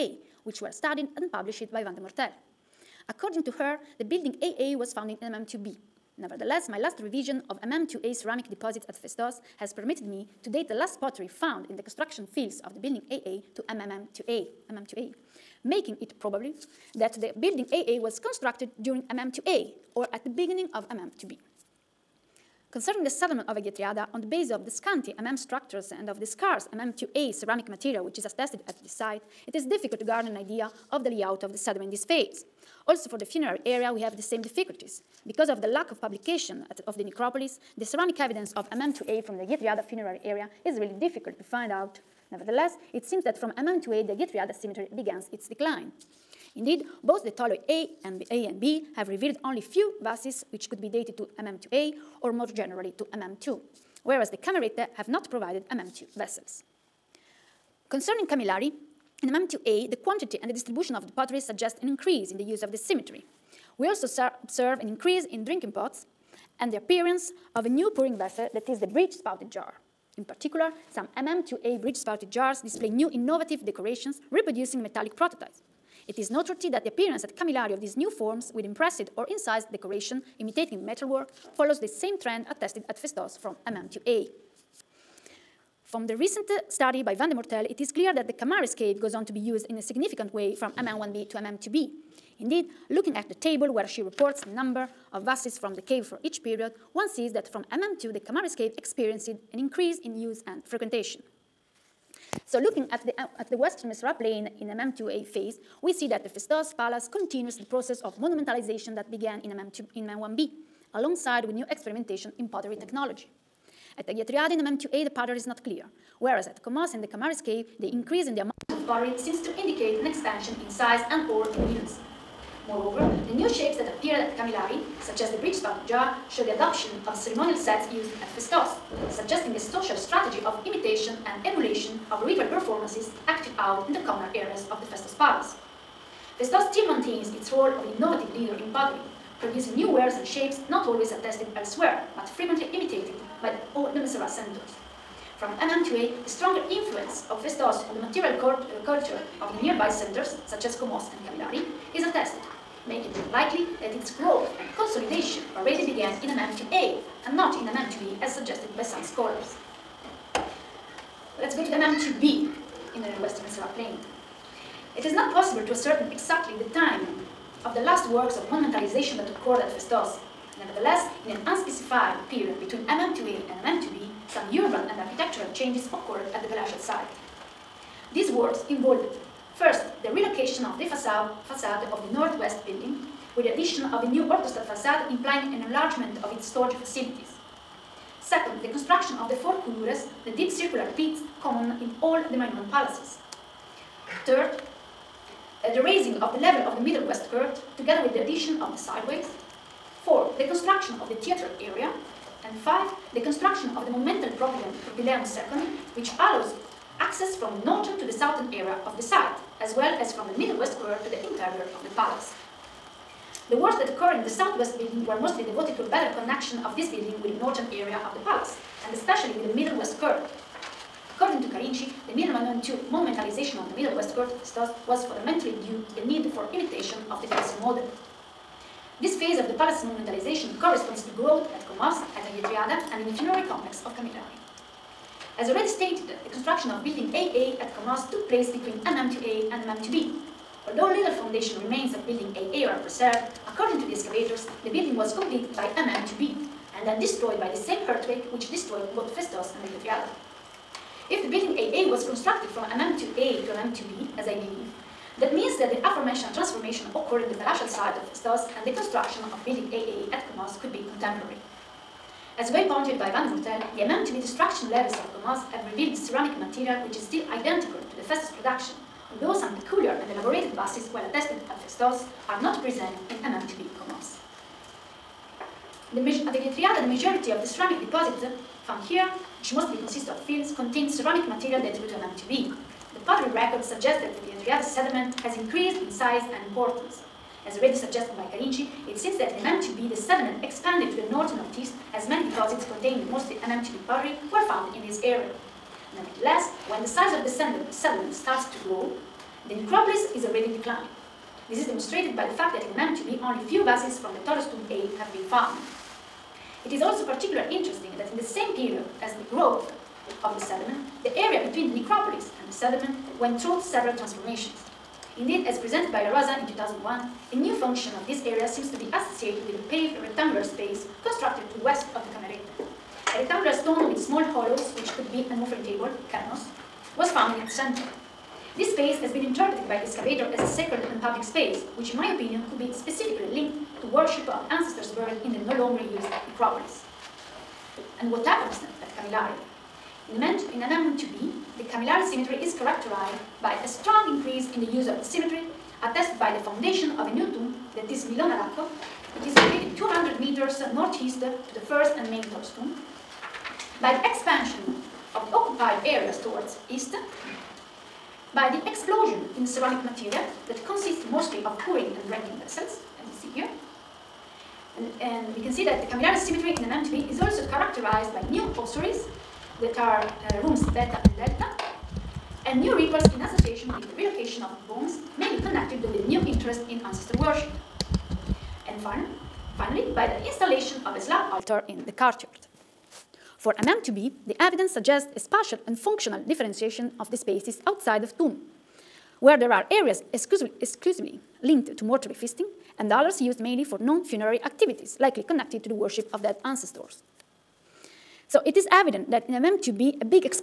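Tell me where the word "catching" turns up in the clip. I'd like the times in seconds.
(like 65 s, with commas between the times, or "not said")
not said.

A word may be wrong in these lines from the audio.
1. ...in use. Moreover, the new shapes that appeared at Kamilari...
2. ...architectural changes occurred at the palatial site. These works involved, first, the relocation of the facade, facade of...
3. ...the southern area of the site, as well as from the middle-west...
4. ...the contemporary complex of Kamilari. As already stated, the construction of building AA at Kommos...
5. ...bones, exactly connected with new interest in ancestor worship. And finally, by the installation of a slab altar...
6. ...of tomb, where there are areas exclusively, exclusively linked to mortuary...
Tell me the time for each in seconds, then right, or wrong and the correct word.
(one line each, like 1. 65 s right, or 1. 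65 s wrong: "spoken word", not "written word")
1. 121 s right
2. 174 s right
3. 208 s right
4. 233 s wrong: "funerary", not "contemporary"
5. 374 s wrong: "mainly", not "exactly"
6. 388 s right.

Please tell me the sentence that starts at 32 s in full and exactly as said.
Also for the funerary area, we have the same difficulties.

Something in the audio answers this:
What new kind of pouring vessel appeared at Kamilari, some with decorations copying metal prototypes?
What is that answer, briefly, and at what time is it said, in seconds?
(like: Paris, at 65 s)
bridge spouted jar, at 68 s.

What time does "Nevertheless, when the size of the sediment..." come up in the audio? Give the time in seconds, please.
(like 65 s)
295 s.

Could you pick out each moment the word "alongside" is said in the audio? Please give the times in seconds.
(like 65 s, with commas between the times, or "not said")
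110 s.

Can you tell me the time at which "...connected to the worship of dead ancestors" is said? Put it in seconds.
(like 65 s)
395 s.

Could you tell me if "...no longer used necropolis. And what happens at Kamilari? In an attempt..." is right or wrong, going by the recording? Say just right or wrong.
right.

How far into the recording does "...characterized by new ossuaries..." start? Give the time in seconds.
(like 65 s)
367 s.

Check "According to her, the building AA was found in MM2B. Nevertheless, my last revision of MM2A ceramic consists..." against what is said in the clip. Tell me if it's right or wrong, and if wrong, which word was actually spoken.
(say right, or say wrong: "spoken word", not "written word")
wrong: "deposits", not "consists".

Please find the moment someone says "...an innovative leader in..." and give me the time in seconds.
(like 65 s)
137 s.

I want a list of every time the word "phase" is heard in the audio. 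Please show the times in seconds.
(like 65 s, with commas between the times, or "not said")
32 s, 105 s, 229 s.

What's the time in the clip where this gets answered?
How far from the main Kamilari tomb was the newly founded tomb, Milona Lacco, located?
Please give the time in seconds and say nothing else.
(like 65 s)
349 s.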